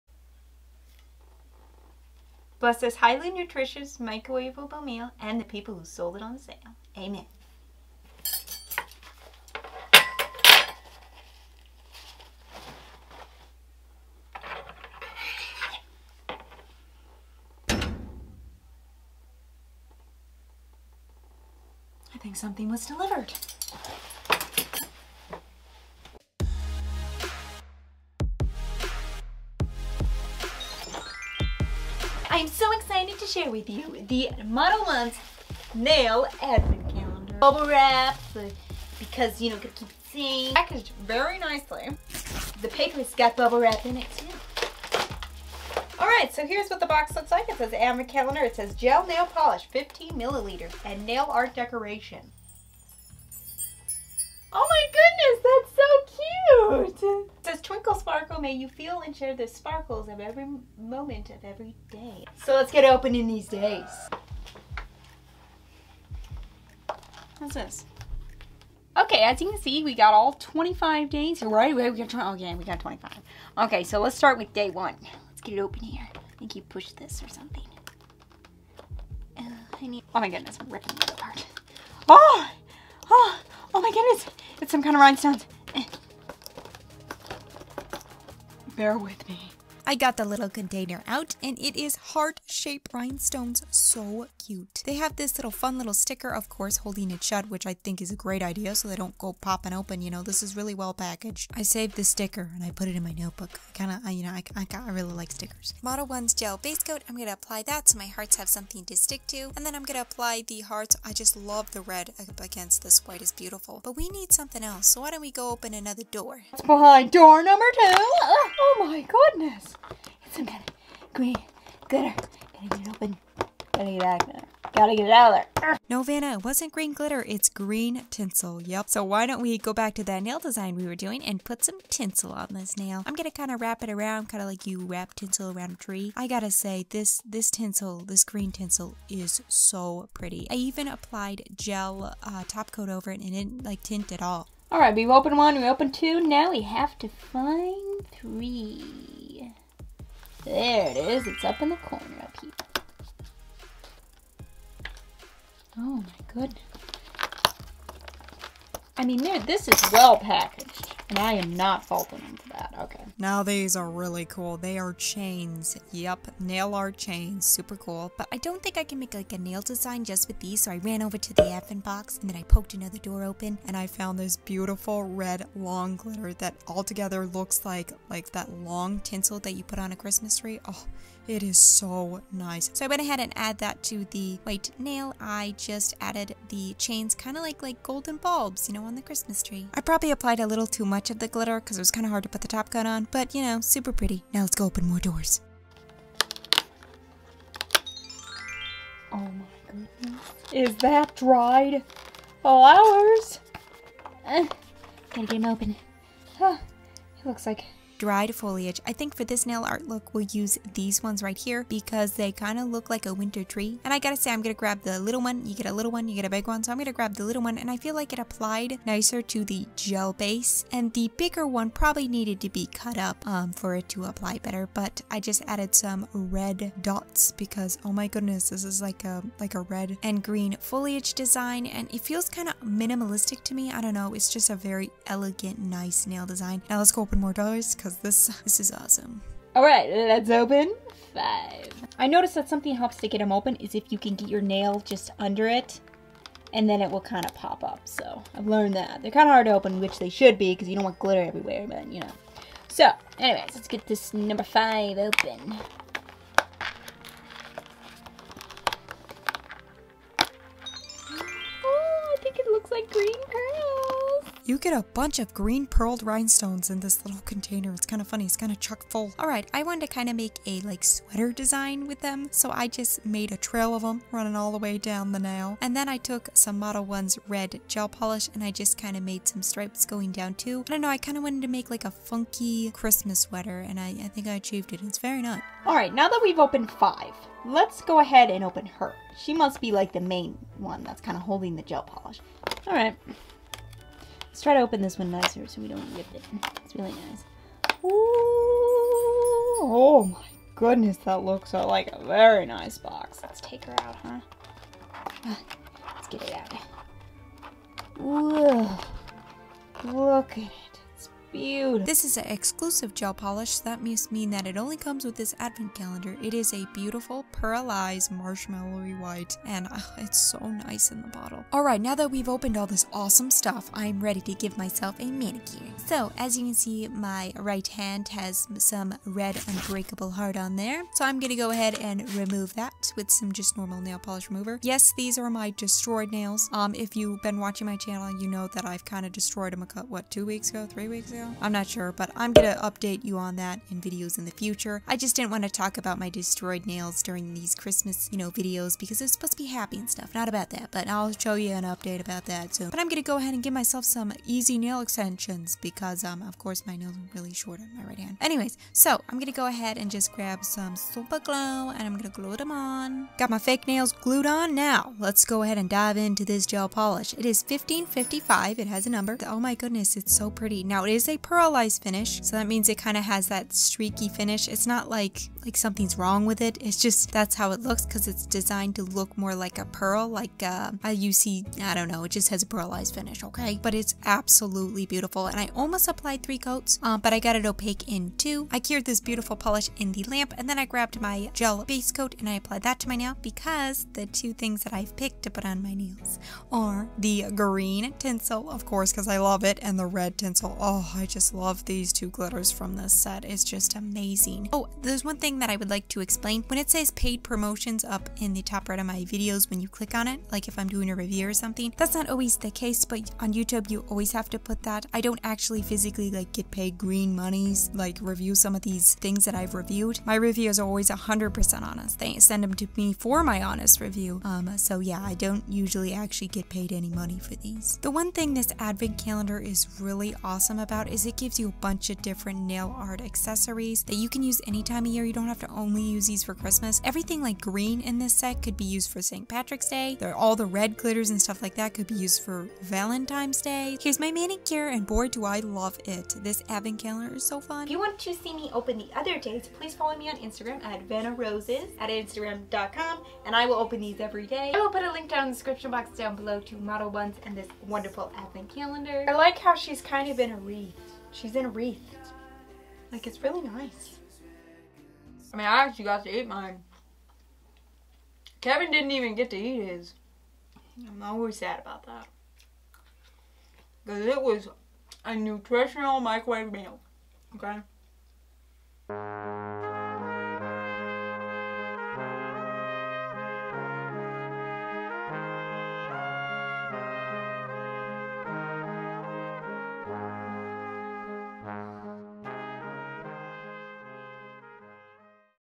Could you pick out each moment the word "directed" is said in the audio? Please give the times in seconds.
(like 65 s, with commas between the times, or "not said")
not said.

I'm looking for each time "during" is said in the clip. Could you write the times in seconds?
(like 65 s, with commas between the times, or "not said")
347 s.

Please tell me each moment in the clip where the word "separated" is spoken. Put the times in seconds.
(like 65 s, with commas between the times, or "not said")
not said.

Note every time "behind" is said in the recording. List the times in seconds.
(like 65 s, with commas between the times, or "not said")
116 s.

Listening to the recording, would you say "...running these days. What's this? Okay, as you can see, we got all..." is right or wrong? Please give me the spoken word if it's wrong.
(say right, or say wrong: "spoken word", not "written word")
wrong: "opening", not "running".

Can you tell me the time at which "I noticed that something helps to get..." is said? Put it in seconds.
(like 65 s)
241 s.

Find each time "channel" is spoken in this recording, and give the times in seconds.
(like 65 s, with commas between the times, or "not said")
337 s.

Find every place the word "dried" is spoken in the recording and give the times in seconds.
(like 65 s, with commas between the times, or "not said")
201 s, 208 s.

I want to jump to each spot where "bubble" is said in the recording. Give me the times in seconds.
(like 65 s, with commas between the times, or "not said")
37 s, 43 s.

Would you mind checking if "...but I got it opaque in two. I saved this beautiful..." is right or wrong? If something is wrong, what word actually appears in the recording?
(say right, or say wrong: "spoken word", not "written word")
wrong: "cured", not "saved".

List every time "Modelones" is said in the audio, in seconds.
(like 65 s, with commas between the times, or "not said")
34 s, 105 s, 276 s, 456 s.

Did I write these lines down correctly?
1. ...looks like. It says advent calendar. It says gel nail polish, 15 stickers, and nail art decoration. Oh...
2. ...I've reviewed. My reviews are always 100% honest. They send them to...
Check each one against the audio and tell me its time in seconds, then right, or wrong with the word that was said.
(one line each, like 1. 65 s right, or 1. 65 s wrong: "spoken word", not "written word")
1. 47 s wrong: "milliliters", not "stickers"
2. 419 s right.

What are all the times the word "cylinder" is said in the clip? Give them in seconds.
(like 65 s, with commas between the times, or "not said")
not said.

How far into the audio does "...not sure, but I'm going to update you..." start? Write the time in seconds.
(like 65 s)
341 s.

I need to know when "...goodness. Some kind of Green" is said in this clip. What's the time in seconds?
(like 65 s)
119 s.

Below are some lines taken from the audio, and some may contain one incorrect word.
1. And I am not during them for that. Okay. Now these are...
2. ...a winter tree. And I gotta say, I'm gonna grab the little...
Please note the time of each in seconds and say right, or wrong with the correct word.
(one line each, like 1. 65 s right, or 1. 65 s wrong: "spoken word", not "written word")
1. 161 s wrong: "faulting", not "during"
2. 213 s right.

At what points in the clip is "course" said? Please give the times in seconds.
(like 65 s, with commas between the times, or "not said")
96 s, 356 s, 398 s.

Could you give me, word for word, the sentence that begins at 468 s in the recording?
Kevin didn't even get to eat his.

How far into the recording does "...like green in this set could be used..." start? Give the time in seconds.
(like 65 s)
437 s.